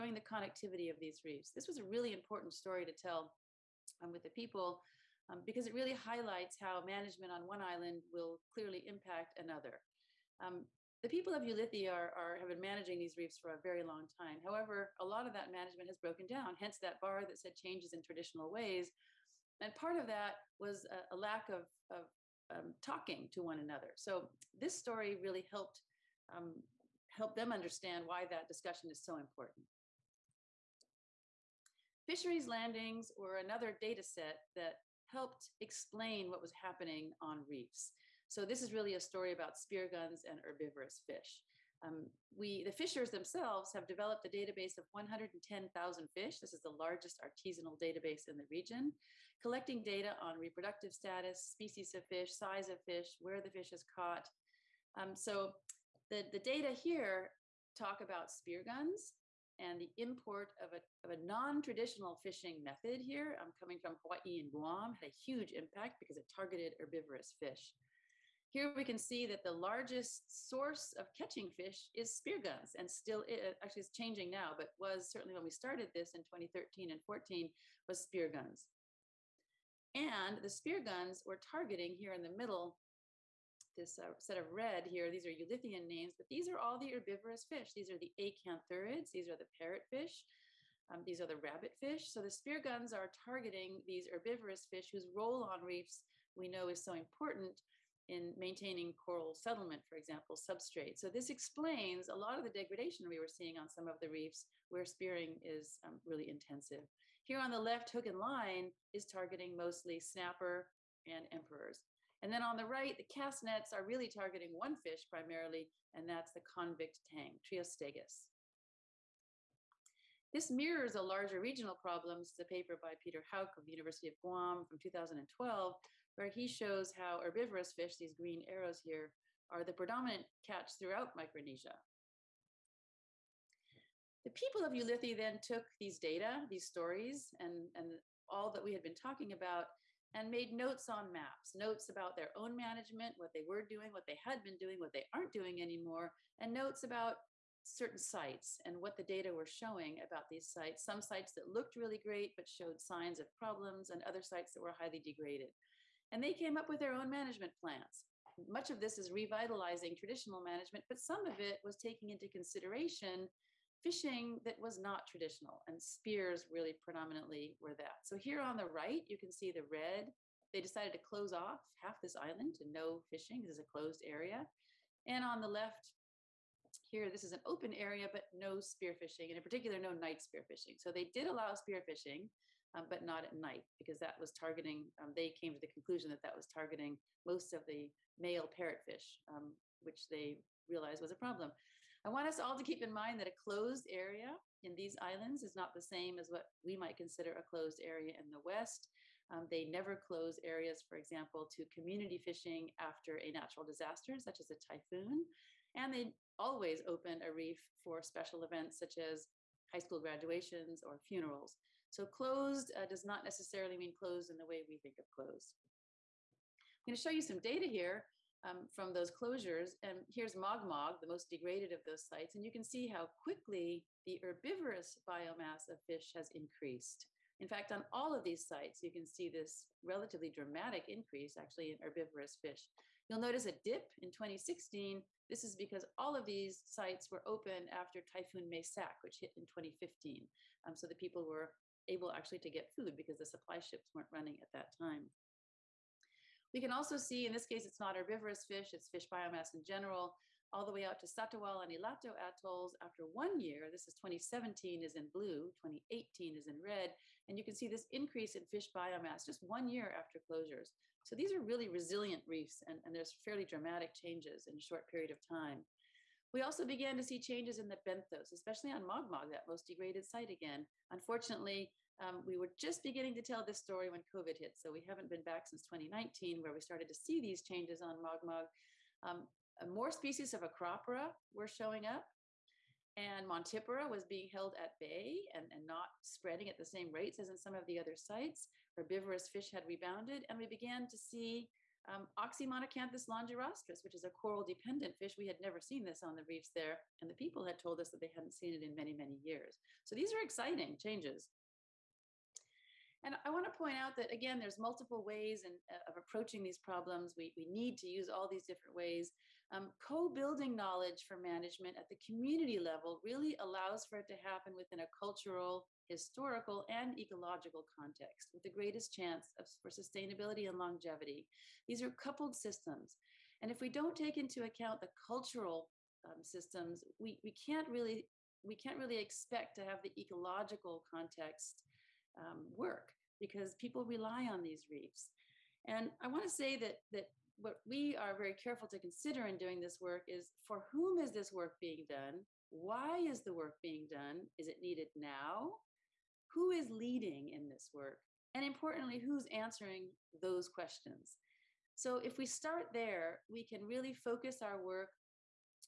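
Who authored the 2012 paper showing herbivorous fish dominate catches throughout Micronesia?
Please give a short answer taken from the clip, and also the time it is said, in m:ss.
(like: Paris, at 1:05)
Peter Houk, at 2:03.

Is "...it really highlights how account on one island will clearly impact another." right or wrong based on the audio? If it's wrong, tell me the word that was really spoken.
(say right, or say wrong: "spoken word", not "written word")
wrong: "management", not "account".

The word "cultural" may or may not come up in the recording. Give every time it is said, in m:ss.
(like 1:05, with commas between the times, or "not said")
5:15, 5:25.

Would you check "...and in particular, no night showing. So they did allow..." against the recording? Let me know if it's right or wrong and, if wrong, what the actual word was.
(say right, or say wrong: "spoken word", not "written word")
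wrong: "spearfishing", not "showing".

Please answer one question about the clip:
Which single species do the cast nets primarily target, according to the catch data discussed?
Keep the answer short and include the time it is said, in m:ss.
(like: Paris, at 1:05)
convict tang, at 1:56.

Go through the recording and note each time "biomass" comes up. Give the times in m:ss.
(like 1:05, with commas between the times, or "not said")
3:45, 4:09, 4:18.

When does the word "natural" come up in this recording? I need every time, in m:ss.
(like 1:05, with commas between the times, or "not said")
3:23.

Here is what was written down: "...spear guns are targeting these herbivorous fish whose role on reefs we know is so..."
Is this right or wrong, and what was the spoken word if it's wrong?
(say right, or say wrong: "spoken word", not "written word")
right.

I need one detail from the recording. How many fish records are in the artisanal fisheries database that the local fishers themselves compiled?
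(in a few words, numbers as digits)
110,000.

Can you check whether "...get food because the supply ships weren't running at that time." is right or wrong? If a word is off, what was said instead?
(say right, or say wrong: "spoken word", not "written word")
right.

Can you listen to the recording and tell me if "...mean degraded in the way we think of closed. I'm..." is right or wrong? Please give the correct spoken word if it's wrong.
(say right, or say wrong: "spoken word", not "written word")
wrong: "closed", not "degraded".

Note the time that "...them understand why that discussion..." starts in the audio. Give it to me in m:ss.
0:27.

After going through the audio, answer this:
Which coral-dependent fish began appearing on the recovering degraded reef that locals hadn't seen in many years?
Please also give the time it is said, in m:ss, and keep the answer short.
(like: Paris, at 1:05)
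Oxymonacanthus longirostris, at 4:52.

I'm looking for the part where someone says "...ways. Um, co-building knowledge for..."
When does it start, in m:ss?
5:08.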